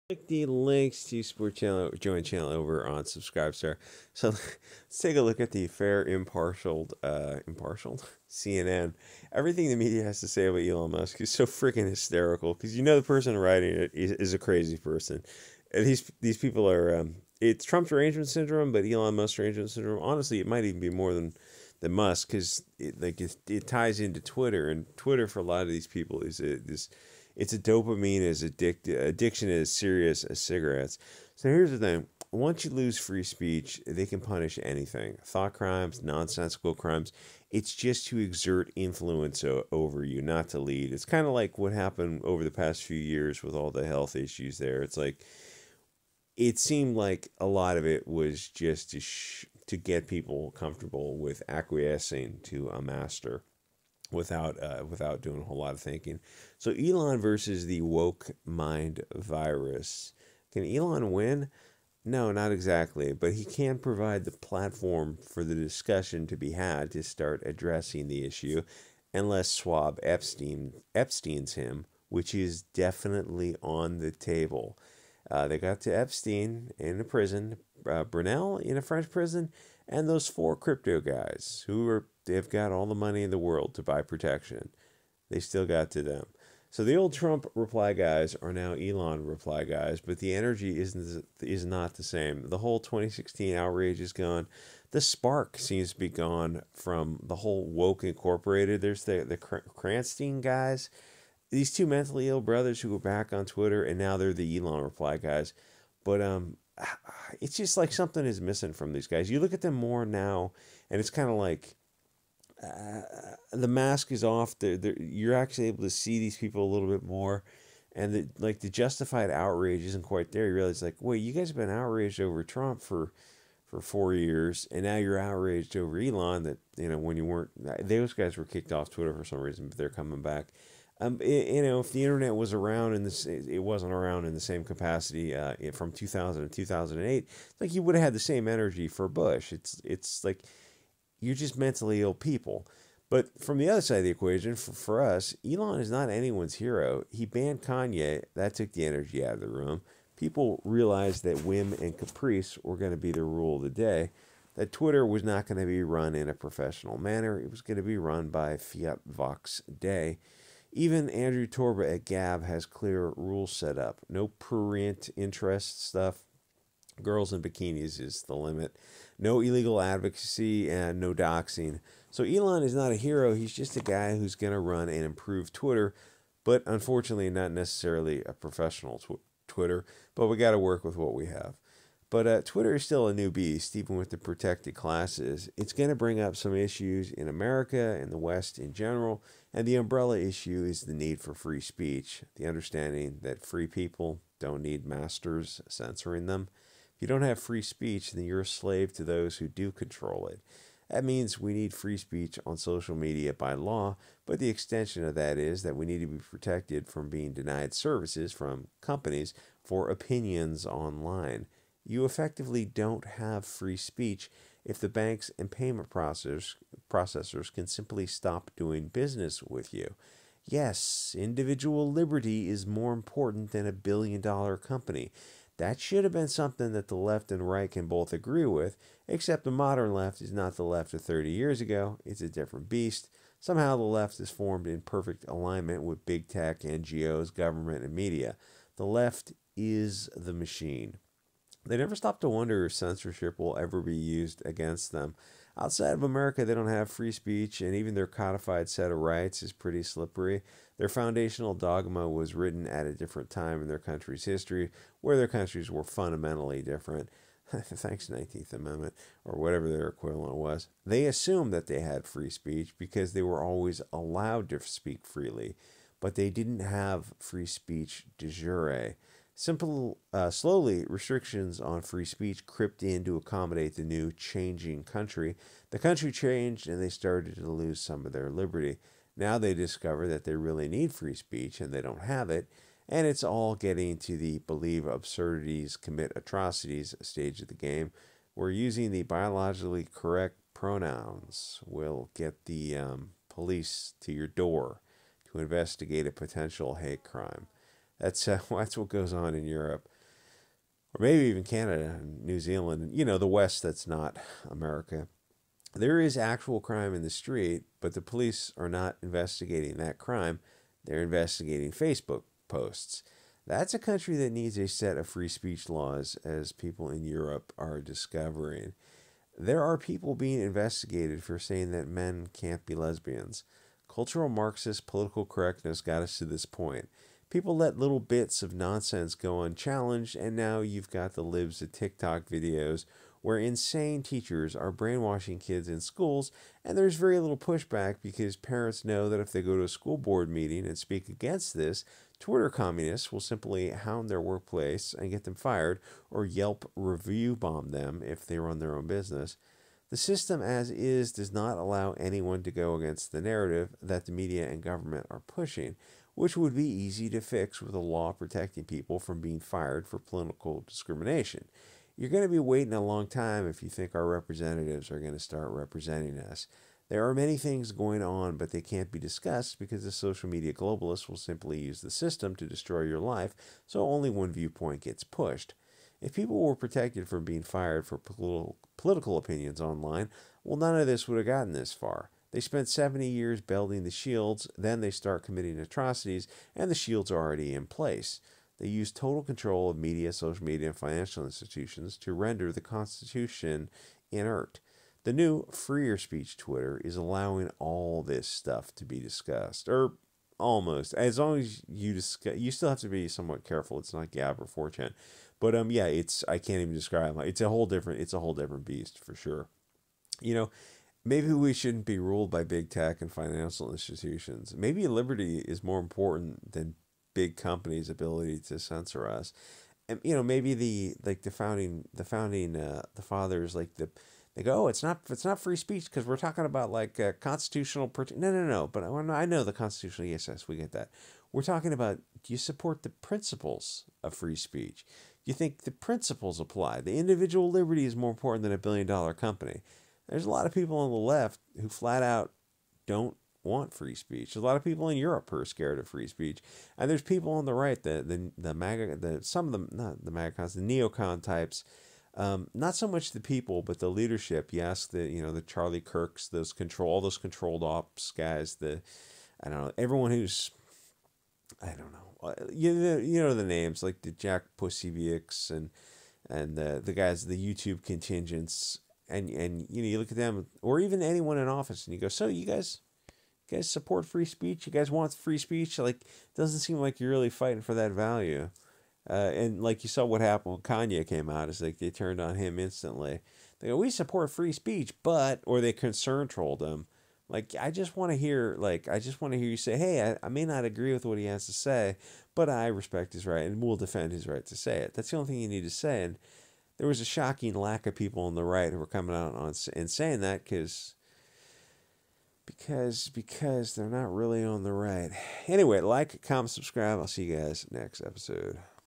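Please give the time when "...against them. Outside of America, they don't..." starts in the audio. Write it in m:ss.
4:04.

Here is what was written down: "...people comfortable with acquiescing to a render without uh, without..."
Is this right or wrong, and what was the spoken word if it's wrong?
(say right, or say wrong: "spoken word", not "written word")
wrong: "master", not "render".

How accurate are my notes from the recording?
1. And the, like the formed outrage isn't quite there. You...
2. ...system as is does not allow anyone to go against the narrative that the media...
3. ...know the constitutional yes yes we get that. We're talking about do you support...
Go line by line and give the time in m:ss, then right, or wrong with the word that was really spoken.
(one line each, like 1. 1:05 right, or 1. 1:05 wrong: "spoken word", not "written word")
1. 1:57 wrong: "justified", not "formed"
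2. 5:49 right
3. 7:09 right.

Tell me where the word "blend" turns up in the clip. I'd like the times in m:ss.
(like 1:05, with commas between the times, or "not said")
not said.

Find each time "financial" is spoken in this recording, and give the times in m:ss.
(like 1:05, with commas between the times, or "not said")
6:30, 6:53.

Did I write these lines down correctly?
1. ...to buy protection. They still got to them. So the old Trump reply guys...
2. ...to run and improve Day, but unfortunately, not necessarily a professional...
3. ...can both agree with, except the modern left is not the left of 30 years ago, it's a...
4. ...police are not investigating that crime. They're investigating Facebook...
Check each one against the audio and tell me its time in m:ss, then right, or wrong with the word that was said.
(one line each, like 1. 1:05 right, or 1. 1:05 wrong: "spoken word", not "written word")
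1. 1:23 right
2. 2:54 wrong: "Twitter", not "Day"
3. 3:47 right
4. 5:08 right.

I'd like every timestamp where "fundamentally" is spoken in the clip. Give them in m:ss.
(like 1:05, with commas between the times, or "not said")
4:15.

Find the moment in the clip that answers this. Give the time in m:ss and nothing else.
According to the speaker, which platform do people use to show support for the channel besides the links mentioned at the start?
0:03.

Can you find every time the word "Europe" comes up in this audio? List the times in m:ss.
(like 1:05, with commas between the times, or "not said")
4:59, 5:17, 7:24.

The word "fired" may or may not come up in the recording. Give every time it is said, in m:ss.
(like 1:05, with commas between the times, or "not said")
5:45, 5:59, 6:17.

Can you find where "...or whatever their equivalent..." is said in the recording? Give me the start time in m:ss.
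4:19.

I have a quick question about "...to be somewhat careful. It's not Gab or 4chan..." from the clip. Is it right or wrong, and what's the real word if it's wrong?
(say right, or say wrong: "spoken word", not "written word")
right.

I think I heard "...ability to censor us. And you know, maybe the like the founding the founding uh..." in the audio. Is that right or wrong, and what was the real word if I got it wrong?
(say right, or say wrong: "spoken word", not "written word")
right.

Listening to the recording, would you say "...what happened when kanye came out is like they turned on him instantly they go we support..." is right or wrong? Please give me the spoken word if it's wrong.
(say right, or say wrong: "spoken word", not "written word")
right.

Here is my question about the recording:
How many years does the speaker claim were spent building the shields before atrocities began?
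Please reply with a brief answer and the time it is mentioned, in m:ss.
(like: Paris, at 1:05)
70, at 6:22.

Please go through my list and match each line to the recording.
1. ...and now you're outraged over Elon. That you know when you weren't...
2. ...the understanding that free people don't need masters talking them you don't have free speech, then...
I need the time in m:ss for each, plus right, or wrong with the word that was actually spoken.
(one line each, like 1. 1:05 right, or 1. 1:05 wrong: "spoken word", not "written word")
1. 2:04 right
2. 3:12 wrong: "censoring", not "talking".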